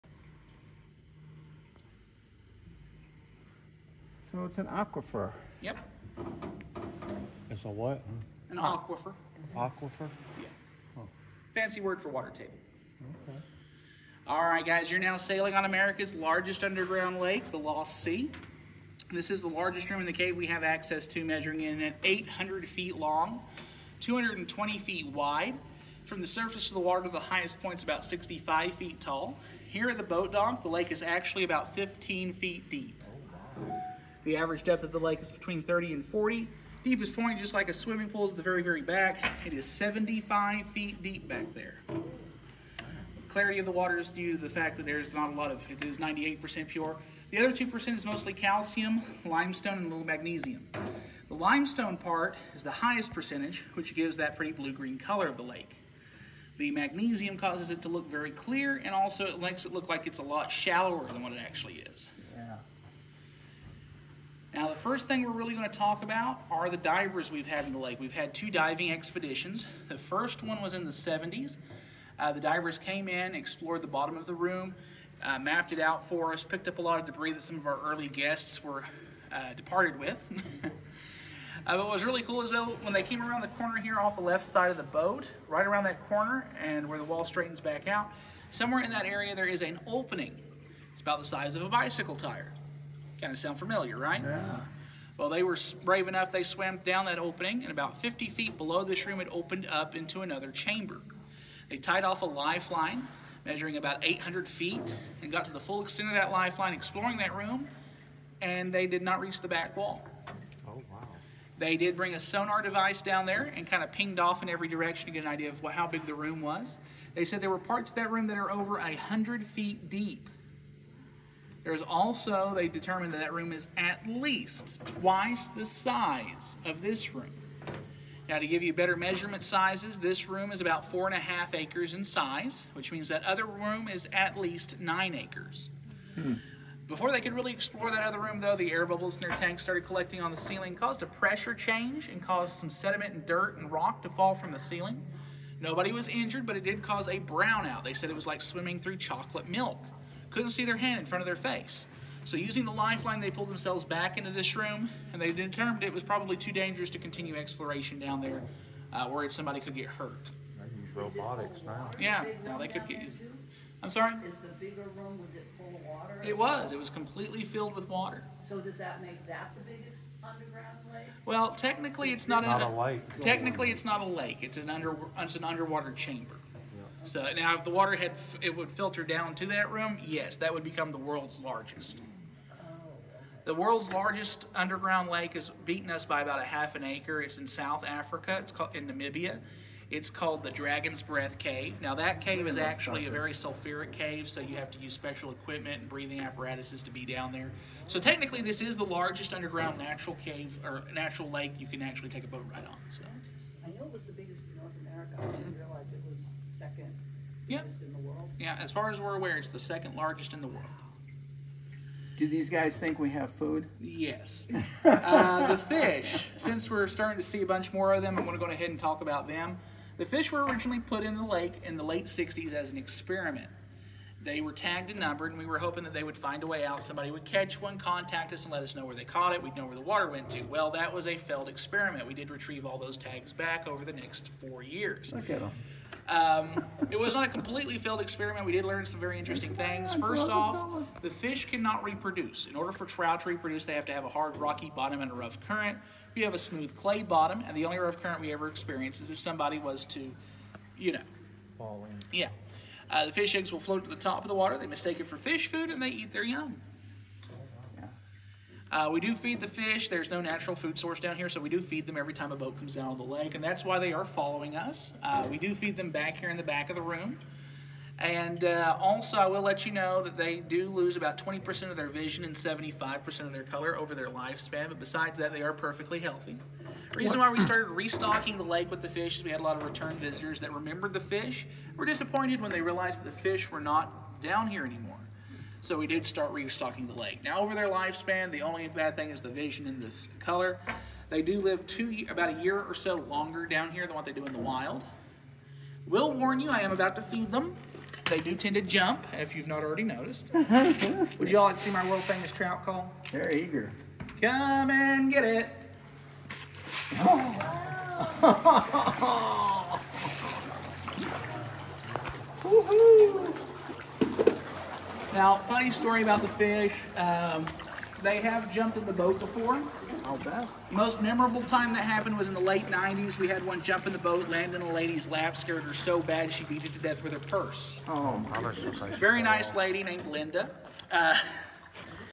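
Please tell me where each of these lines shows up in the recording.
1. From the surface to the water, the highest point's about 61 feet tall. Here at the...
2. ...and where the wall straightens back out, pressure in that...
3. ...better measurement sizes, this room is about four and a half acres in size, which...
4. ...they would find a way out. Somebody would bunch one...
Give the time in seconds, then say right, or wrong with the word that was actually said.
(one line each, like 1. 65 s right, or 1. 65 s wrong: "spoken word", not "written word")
1. 26 s wrong: "65", not "61"
2. 86 s wrong: "somewhere", not "pressure"
3. 128 s right
4. 225 s wrong: "catch", not "bunch".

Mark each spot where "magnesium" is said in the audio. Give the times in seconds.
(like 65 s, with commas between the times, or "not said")
50 s, 56 s.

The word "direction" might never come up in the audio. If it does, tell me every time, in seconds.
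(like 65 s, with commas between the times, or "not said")
114 s.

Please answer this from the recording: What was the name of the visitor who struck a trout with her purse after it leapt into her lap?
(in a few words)
Linda.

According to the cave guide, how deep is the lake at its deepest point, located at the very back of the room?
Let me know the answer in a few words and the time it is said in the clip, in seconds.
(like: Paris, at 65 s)
75 feet, at 39 s.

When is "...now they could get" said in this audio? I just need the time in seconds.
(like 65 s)
162 s.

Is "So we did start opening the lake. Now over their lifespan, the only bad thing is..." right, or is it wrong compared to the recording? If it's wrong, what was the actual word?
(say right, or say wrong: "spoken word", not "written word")
wrong: "restocking", not "opening".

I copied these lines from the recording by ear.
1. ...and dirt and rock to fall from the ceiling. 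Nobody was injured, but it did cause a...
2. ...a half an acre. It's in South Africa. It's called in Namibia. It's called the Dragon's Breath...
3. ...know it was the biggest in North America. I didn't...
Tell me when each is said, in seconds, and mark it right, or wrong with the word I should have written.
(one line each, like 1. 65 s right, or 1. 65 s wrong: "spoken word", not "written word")
1. 143 s right
2. 186 s right
3. 203 s right.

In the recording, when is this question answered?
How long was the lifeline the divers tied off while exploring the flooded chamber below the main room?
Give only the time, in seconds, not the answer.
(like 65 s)
103 s.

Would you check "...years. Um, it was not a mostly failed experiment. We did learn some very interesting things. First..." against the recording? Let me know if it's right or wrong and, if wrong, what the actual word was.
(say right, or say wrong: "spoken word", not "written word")
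wrong: "completely", not "mostly".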